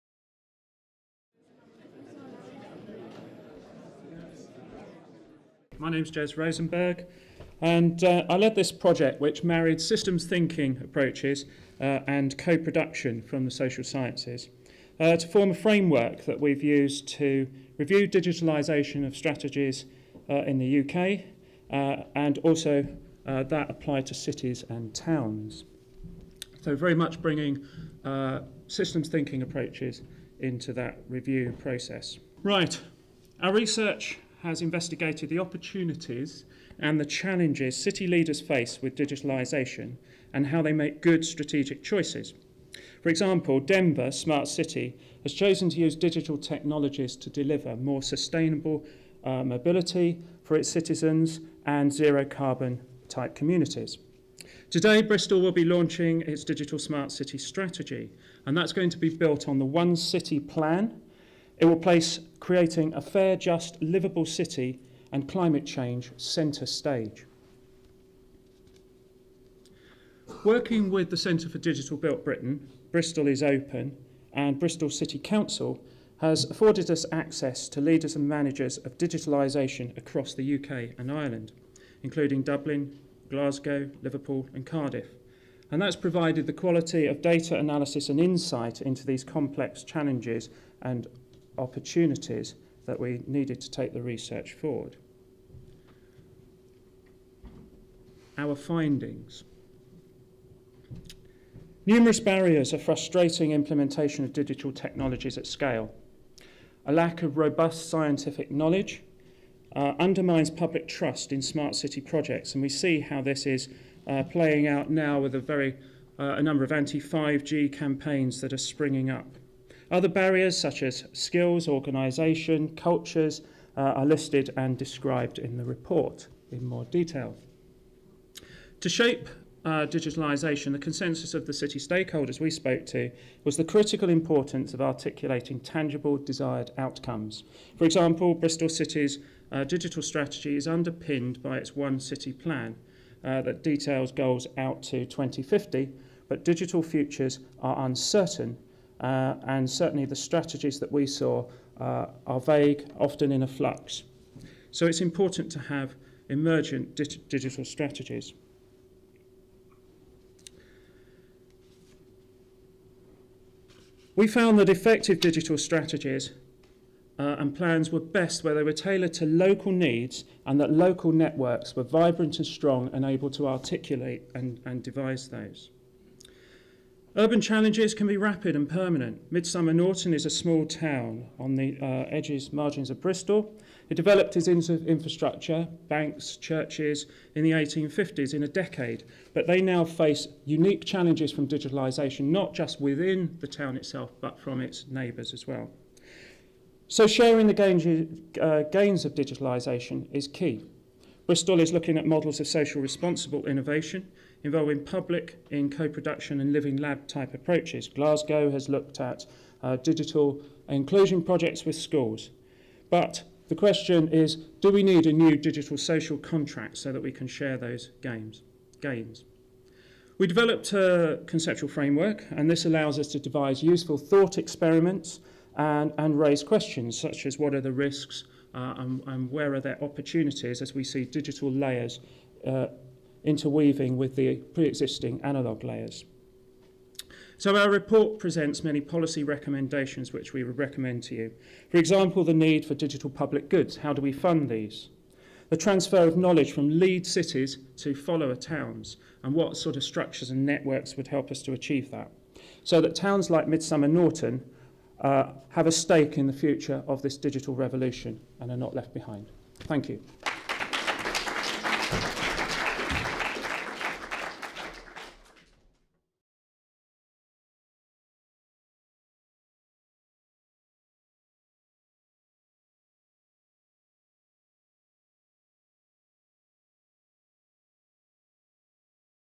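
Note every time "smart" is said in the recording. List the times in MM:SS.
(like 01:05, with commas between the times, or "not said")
00:44, 00:56, 01:51.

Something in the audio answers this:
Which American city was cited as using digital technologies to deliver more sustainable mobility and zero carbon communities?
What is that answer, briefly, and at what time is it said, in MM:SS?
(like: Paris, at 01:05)
Denver, at 00:43.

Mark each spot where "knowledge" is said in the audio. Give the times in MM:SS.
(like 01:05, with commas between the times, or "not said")
01:48, 04:06.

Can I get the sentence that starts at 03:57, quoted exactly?
So our report presents many policy recommendations which we would recommend to you.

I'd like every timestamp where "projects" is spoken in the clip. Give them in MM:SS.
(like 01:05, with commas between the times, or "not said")
00:08, 01:52, 03:31.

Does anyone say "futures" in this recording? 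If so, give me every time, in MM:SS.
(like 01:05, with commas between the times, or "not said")
02:26, 04:16.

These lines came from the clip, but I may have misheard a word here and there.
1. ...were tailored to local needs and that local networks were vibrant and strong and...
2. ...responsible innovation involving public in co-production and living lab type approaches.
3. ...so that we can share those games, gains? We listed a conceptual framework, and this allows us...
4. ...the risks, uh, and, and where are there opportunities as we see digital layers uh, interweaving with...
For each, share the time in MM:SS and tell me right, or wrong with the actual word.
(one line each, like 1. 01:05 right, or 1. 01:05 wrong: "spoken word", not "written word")
1. 02:48 right
2. 03:22 right
3. 03:36 wrong: "developed", not "listed"
4. 03:47 right.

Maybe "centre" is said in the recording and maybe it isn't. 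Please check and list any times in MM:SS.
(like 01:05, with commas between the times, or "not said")
01:06, 01:11.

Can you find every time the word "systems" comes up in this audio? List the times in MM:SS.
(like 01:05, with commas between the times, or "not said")
00:09, 00:28.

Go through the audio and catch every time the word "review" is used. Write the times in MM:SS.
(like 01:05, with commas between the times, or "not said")
00:17, 00:31.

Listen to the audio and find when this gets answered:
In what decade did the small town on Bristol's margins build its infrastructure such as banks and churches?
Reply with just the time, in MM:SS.
03:07.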